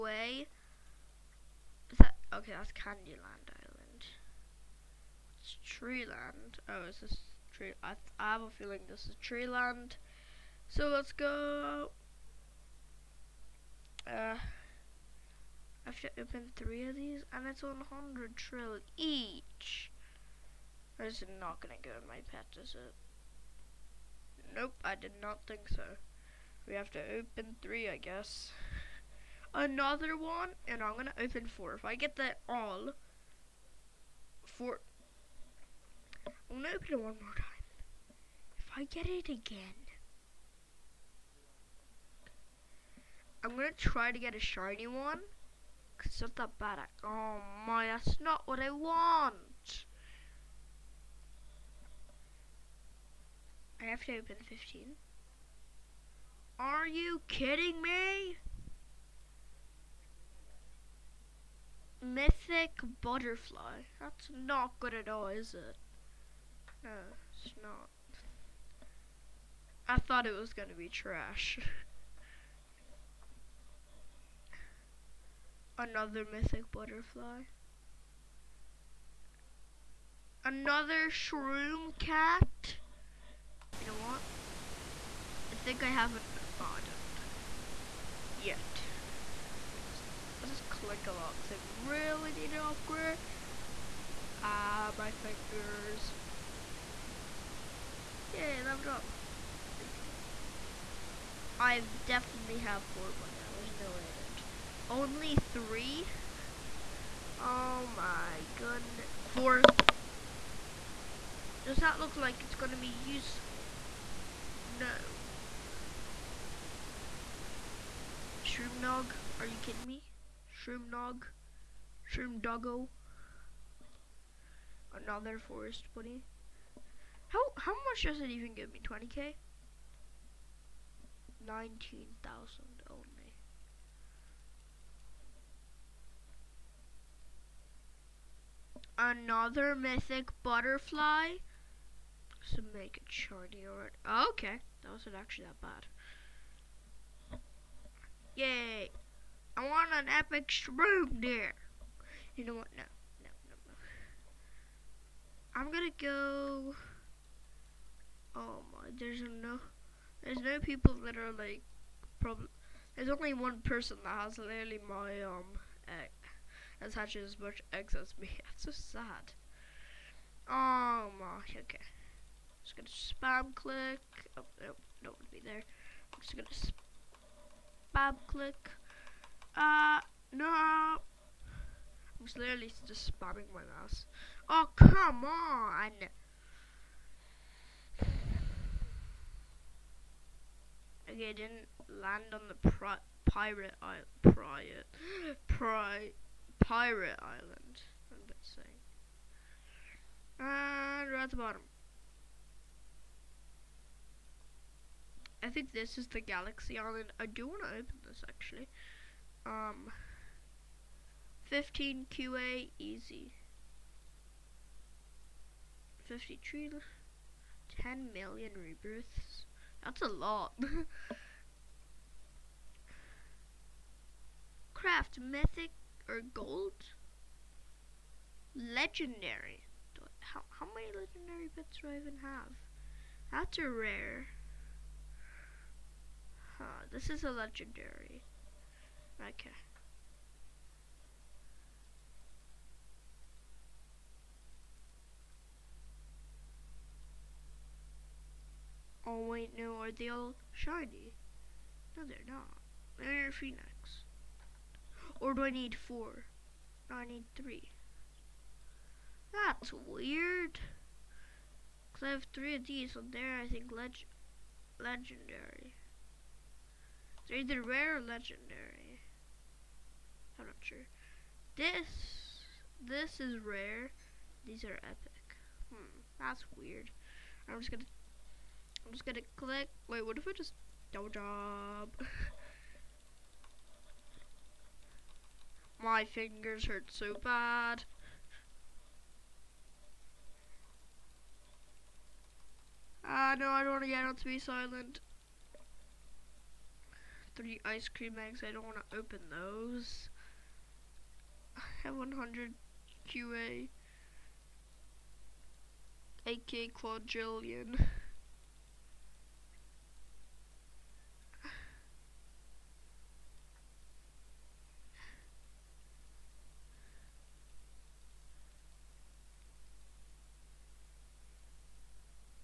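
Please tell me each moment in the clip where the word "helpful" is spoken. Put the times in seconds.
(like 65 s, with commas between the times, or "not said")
not said.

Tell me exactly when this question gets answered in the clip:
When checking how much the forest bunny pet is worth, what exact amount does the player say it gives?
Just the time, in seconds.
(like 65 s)
131 s.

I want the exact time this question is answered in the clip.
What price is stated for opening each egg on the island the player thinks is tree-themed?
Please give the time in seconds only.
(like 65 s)
17 s.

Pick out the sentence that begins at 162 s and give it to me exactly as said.
There's only one person that has literally my um, egg, that's had as much eggs as me.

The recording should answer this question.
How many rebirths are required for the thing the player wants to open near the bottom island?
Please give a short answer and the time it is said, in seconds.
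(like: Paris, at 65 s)
10 million, at 217 s.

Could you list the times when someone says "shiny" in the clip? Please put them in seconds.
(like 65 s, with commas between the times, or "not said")
44 s, 143 s, 250 s.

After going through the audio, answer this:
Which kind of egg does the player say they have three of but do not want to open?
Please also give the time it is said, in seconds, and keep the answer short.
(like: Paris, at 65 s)
Ice cream eggs, at 297 s.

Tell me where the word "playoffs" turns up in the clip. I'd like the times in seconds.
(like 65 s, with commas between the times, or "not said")
not said.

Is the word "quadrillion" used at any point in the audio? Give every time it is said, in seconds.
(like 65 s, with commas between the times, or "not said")
306 s.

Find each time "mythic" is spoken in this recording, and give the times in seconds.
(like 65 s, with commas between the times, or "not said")
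62 s, 76 s, 139 s, 225 s.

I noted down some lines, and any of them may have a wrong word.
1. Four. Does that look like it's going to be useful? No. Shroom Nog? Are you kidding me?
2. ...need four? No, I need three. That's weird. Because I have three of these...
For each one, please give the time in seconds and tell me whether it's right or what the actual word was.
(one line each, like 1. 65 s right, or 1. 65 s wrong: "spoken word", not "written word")
1. 109 s right
2. 255 s right.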